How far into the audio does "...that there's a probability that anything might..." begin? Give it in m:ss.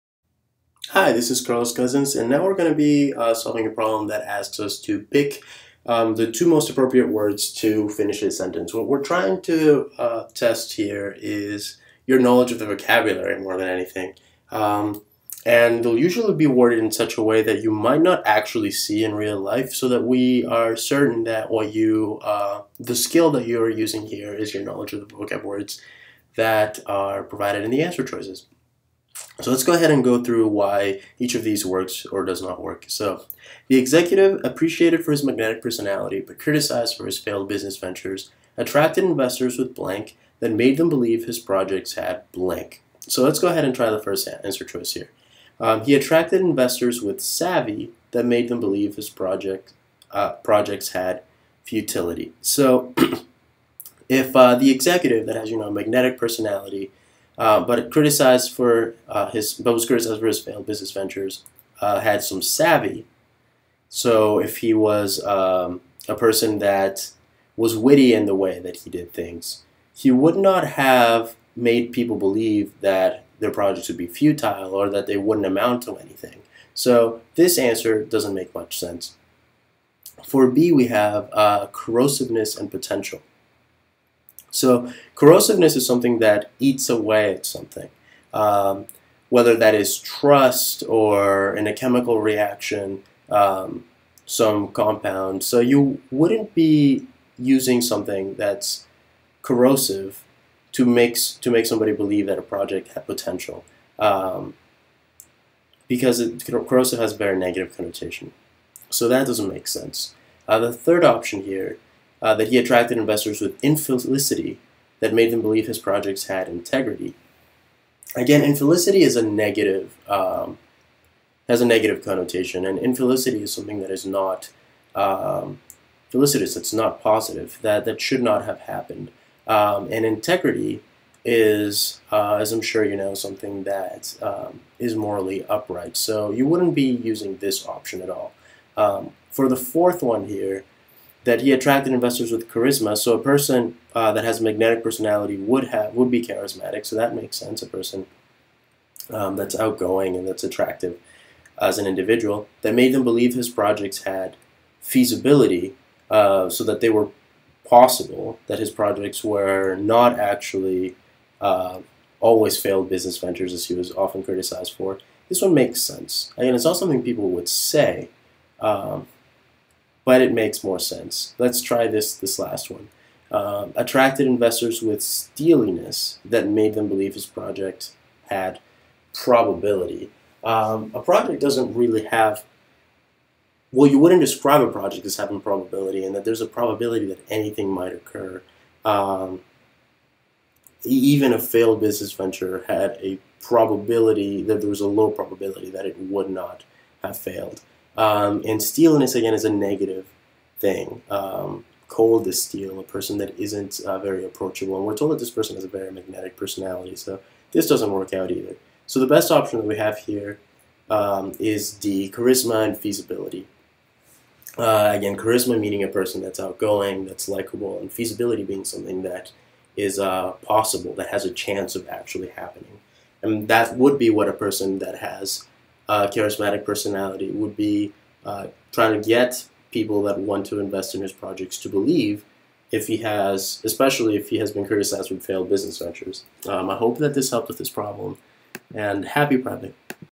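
3:06.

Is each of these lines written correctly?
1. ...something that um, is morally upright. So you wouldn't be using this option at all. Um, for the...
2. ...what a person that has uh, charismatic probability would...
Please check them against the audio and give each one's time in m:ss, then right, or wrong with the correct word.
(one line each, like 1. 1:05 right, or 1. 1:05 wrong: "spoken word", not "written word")
1. 2:13 right
2. 3:44 wrong: "personality", not "probability".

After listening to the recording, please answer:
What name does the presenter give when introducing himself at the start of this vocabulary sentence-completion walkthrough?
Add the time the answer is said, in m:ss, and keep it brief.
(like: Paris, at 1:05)
Carlos Cousins, at 0:01.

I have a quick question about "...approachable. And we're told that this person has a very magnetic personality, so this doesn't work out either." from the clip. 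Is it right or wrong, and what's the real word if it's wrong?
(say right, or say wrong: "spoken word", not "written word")
right.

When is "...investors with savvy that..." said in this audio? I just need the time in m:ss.
0:46.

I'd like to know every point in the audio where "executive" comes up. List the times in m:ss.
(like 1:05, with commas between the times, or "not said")
0:33, 0:54.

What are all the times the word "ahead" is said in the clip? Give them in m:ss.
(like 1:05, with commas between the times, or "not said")
0:29, 0:43.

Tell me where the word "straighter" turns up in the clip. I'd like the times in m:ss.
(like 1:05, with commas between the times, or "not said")
not said.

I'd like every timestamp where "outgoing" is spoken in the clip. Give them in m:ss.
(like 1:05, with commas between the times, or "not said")
2:29, 3:36.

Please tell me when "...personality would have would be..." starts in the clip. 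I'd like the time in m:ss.
2:24.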